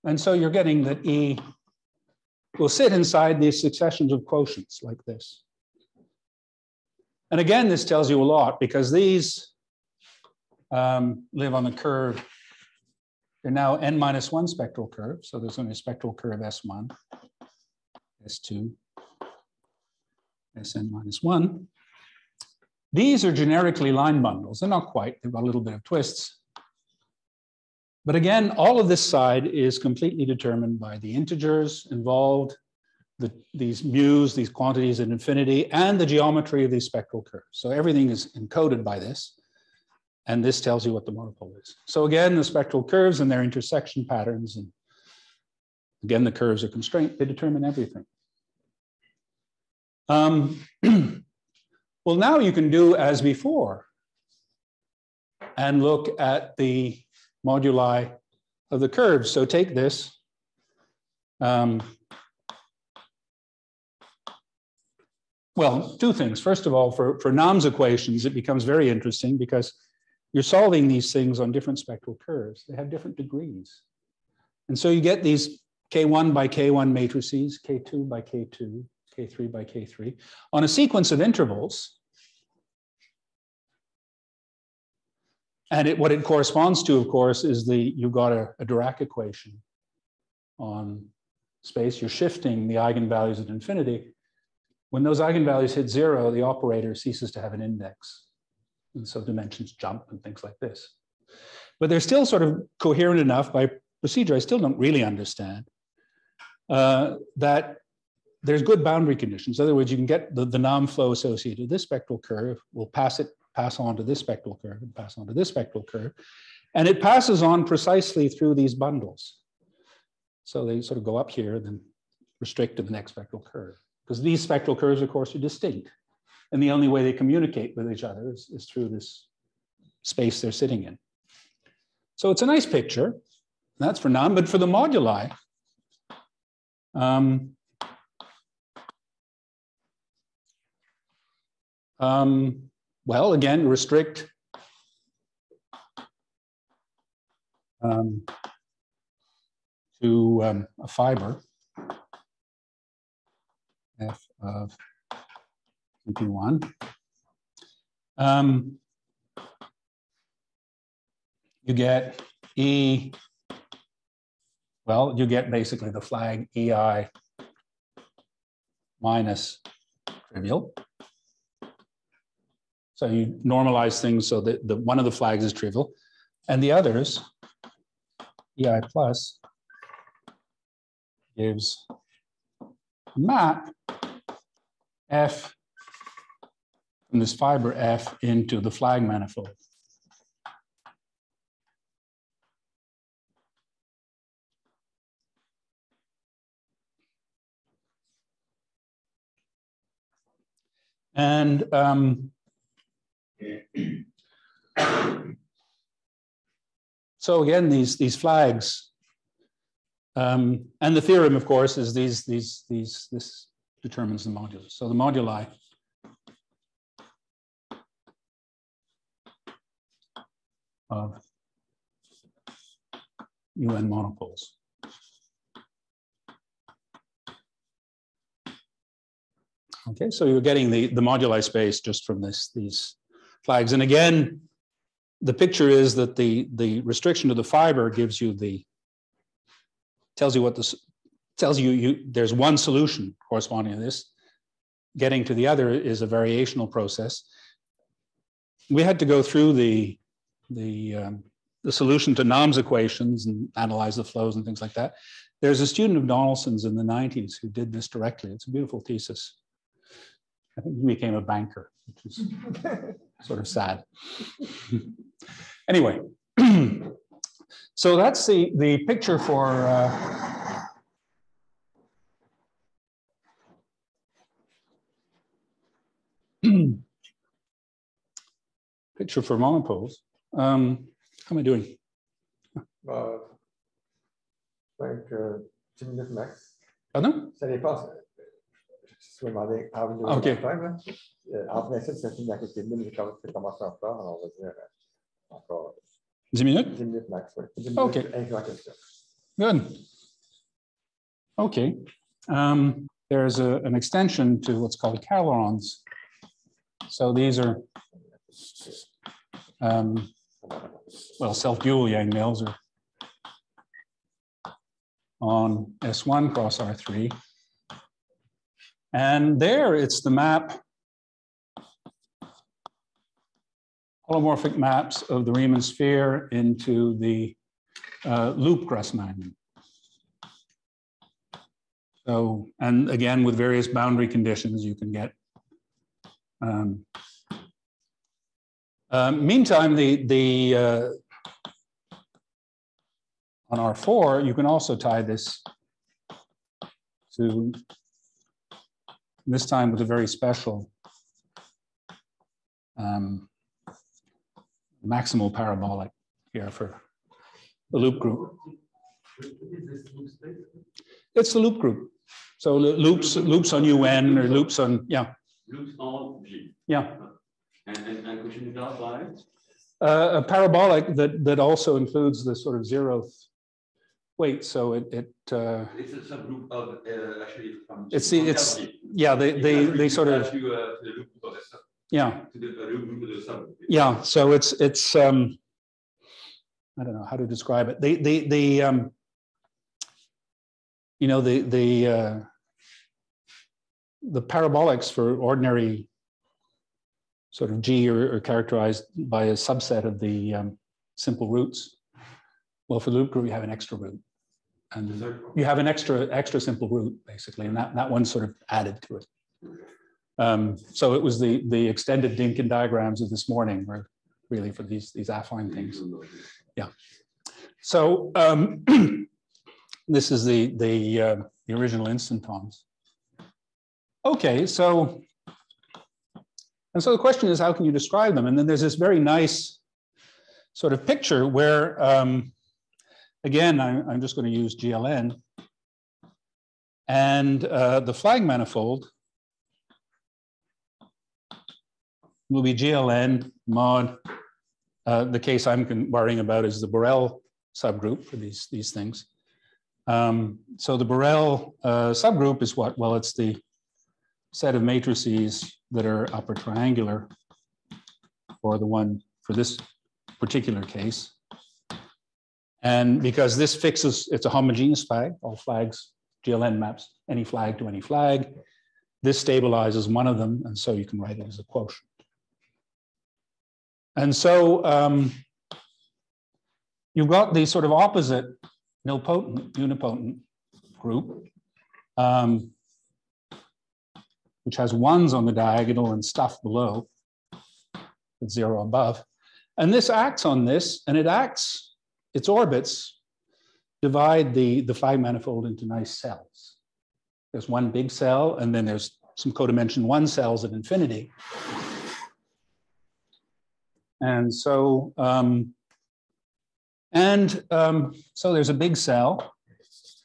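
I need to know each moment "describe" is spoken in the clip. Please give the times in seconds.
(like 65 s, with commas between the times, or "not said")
387 s, 427 s.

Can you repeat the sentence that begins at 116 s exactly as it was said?
And it passes on precisely through these bundles.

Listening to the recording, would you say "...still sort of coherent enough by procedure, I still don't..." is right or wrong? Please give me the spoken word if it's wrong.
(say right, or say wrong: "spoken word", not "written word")
right.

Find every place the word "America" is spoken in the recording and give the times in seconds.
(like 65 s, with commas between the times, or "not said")
not said.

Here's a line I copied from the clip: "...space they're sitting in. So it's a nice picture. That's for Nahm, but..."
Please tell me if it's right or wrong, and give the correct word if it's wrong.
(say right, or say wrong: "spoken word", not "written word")
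right.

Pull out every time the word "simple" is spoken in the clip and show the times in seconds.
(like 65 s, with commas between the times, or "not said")
400 s, 406 s.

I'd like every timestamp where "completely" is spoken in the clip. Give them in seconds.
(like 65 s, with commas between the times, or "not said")
29 s.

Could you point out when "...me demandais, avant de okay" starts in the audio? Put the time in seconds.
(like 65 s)
289 s.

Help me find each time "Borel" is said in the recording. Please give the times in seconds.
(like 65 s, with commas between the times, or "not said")
446 s, 450 s.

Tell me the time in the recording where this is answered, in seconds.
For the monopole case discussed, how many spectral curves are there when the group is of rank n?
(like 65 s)
13 s.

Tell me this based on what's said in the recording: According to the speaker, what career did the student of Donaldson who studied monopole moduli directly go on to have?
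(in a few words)
Banker.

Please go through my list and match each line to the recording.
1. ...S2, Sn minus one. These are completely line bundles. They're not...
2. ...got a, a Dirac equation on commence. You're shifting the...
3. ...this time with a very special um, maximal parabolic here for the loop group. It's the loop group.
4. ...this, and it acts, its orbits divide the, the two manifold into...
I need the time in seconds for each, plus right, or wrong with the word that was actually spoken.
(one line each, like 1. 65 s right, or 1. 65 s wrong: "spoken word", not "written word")
1. 18 s wrong: "generically", not "completely"
2. 88 s wrong: "space", not "commence"
3. 349 s right
4. 490 s wrong: "five", not "two".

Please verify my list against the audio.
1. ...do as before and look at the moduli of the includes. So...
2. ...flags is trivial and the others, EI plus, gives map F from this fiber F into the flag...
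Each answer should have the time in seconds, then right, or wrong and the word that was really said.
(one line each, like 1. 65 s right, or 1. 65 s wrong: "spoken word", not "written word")
1. 52 s wrong: "curves", not "includes"
2. 175 s right.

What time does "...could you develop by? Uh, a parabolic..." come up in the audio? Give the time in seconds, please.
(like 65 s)
368 s.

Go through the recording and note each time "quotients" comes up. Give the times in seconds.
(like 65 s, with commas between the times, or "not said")
4 s, 471 s.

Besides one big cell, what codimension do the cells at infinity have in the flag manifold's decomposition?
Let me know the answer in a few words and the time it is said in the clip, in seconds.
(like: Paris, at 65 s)
1, at 499 s.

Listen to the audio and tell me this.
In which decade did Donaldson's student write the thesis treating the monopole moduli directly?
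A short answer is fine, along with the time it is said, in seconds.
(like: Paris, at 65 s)
1990s, at 256 s.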